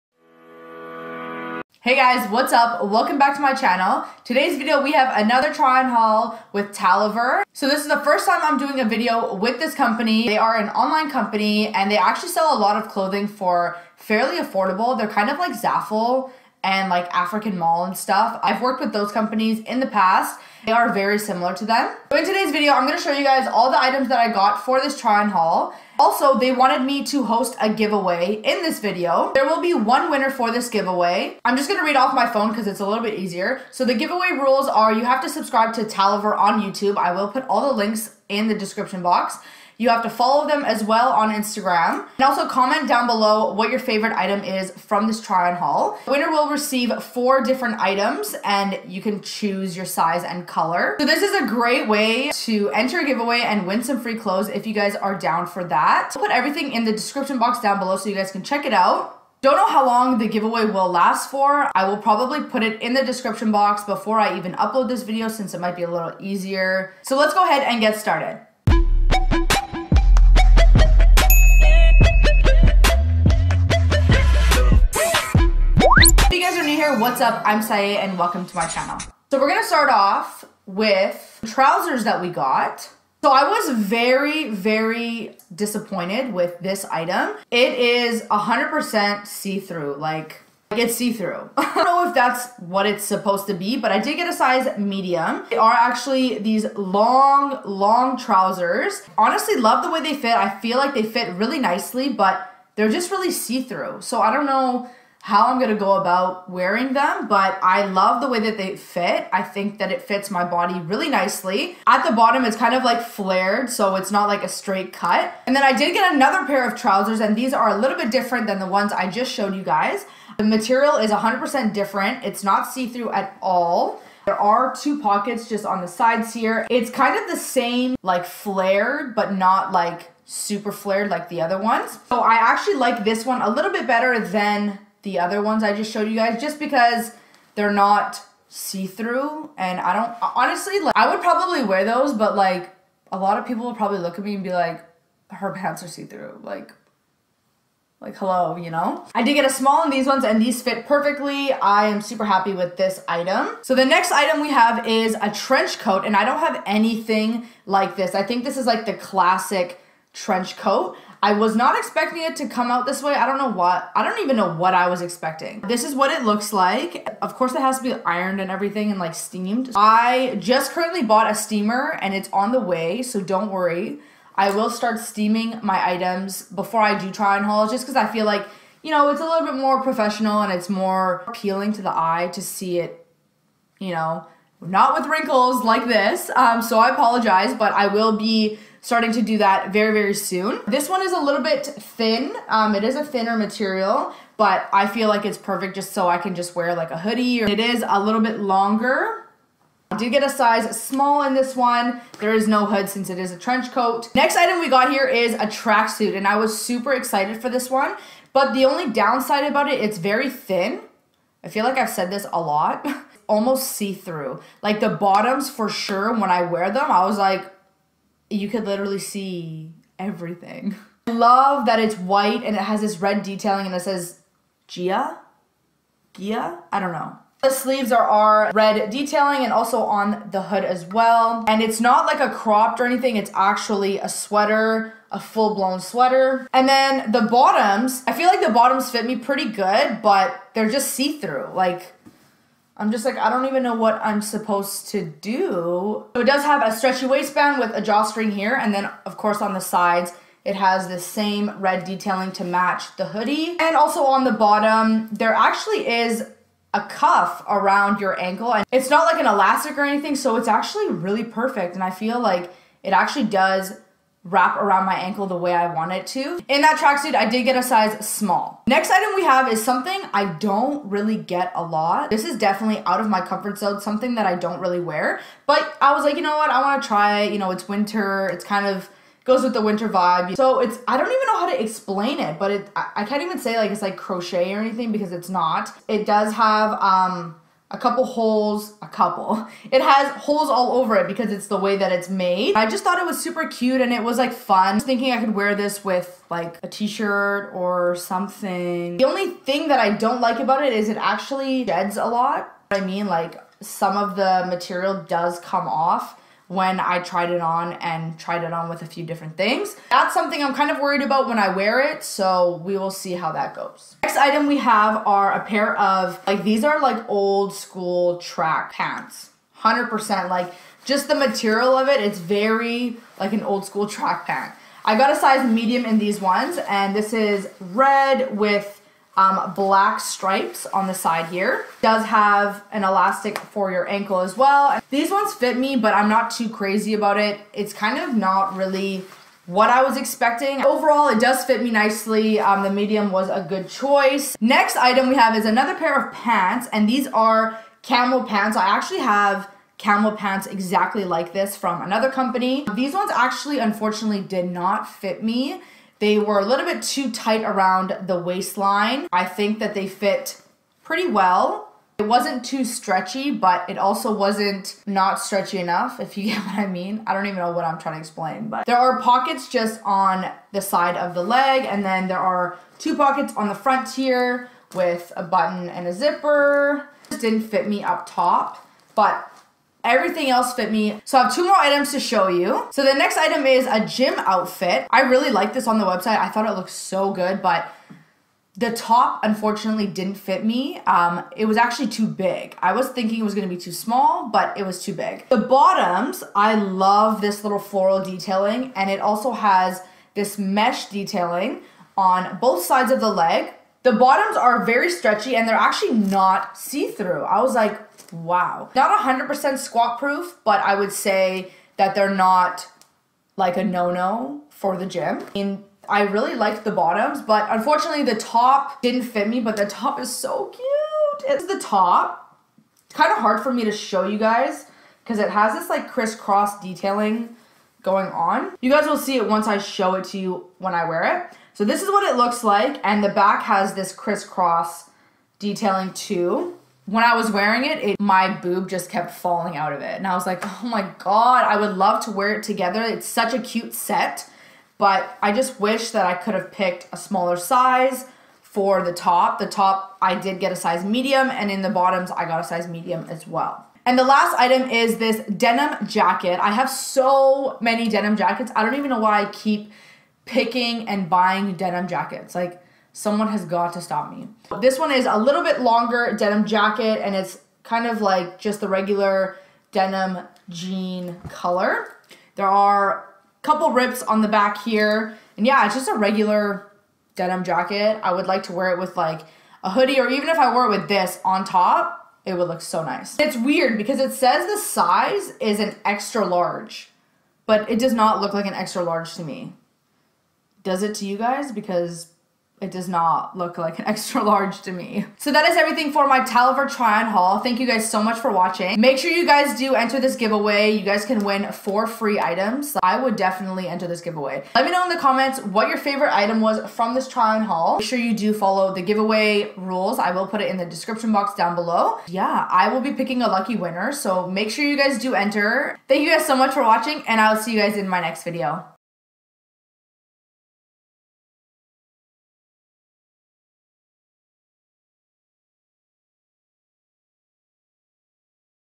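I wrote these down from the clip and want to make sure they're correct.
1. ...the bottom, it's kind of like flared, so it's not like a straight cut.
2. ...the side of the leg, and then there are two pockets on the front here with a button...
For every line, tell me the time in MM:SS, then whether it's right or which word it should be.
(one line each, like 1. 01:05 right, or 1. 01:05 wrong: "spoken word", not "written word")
1. 01:52 right
2. 06:10 right.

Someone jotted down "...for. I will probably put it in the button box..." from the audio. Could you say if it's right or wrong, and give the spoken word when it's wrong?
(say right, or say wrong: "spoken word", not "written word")
wrong: "description", not "button".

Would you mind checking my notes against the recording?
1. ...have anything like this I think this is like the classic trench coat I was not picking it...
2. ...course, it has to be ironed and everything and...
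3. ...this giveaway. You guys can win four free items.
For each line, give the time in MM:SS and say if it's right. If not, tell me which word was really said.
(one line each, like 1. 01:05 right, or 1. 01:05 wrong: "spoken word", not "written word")
1. 02:36 wrong: "expecting", not "picking"
2. 02:47 right
3. 08:19 right.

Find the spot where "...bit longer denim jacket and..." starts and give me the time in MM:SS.
07:45.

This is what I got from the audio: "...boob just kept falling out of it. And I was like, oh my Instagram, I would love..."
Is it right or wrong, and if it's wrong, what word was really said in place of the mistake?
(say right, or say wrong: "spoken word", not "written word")
wrong: "God", not "Instagram".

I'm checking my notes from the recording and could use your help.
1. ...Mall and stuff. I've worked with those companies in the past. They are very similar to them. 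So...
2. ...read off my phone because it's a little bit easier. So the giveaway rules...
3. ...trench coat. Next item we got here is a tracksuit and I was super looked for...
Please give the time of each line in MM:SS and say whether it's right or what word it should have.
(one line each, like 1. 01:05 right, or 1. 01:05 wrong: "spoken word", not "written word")
1. 00:17 right
2. 00:31 right
3. 03:23 wrong: "excited", not "looked".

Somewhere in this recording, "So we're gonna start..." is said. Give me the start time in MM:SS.
01:19.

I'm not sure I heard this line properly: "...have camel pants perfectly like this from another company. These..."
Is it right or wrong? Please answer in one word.
wrong.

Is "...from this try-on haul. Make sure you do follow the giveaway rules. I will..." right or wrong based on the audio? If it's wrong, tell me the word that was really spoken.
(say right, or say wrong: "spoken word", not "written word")
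right.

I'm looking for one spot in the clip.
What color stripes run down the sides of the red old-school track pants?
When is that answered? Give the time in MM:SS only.
05:29.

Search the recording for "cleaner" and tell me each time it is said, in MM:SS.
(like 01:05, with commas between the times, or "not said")
not said.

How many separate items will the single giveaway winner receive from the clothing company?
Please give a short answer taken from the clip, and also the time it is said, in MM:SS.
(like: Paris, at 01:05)
4, at 00:47.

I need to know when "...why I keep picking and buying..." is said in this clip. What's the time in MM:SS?
07:38.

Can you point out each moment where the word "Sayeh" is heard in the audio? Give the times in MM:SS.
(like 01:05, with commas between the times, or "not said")
01:17.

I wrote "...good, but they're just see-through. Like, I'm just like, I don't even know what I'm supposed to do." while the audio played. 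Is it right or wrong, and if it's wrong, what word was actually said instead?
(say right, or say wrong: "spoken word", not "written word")
right.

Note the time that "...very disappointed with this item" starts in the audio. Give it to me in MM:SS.
01:24.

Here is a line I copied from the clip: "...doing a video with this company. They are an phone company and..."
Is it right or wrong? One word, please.
wrong.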